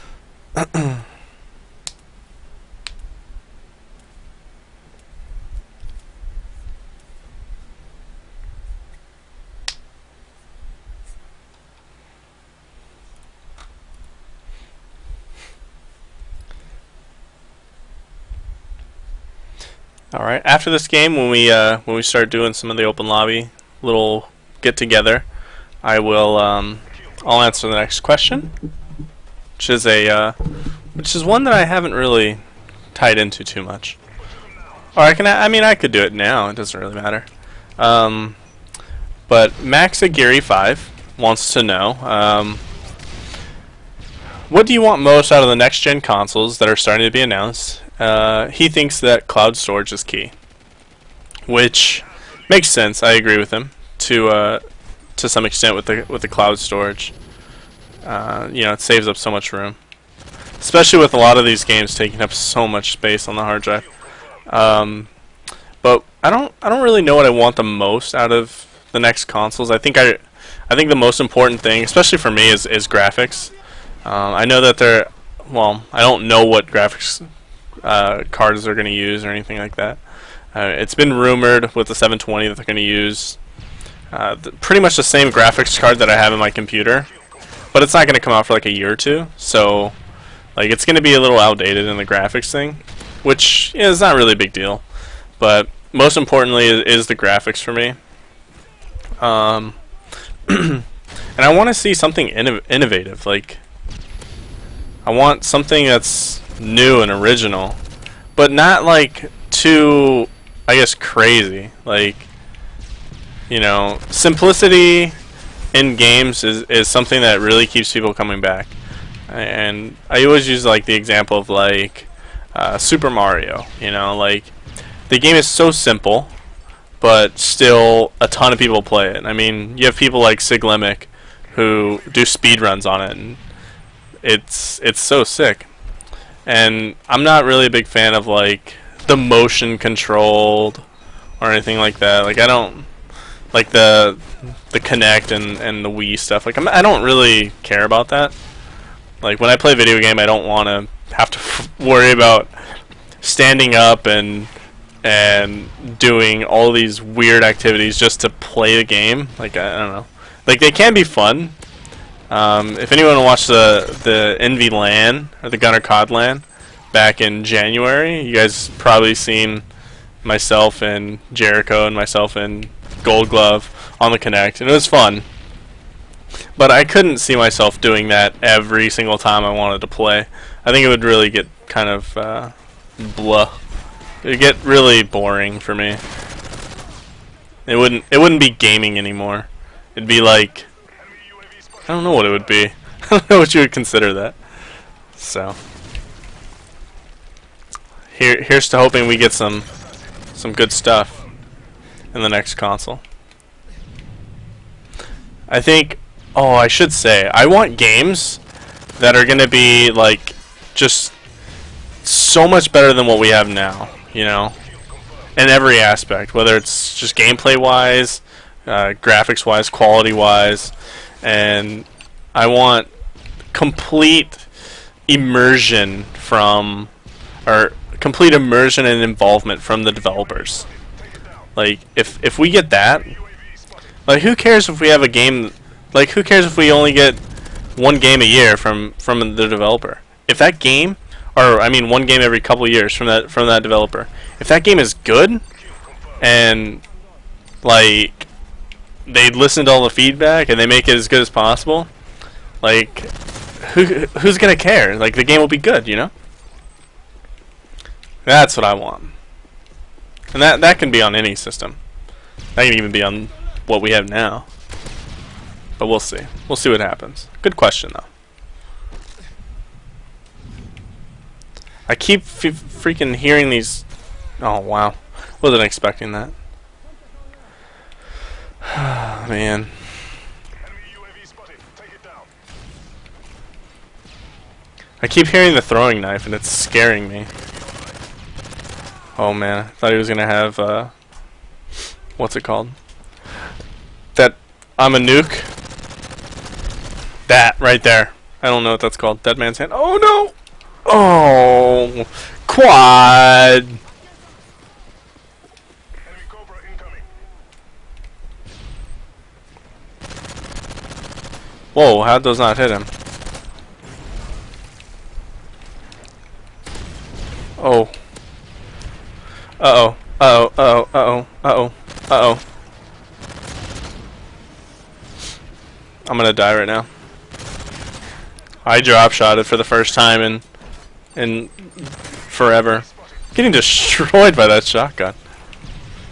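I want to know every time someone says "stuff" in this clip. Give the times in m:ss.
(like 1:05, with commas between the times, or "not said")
2:26, 3:20.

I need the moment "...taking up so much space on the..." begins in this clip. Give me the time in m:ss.
1:01.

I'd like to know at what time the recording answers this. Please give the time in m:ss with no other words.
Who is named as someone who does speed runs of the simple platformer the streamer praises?
2:10.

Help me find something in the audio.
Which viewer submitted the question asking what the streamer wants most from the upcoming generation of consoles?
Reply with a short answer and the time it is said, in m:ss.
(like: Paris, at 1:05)
Max Aguirre five, at 0:39.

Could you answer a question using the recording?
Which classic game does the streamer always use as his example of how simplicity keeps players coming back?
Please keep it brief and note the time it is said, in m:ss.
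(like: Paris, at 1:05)
Super Mario, at 2:02.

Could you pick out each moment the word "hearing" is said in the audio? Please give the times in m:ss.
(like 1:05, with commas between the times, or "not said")
4:33, 4:45.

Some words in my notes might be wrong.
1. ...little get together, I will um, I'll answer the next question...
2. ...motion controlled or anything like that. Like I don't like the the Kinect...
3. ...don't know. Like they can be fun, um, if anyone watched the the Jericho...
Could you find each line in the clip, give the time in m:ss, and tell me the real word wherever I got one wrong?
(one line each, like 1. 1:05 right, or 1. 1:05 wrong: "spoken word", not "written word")
1. 0:23 right
2. 2:19 right
3. 2:39 wrong: "Envy", not "Jericho".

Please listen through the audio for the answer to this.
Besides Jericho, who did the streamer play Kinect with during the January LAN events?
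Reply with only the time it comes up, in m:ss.
2:53.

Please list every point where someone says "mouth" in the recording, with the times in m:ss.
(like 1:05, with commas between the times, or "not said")
not said.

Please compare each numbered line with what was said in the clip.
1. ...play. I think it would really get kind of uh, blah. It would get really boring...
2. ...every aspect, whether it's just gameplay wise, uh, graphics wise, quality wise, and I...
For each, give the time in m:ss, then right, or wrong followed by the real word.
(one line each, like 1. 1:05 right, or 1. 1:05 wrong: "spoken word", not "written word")
1. 2:59 right
2. 3:35 right.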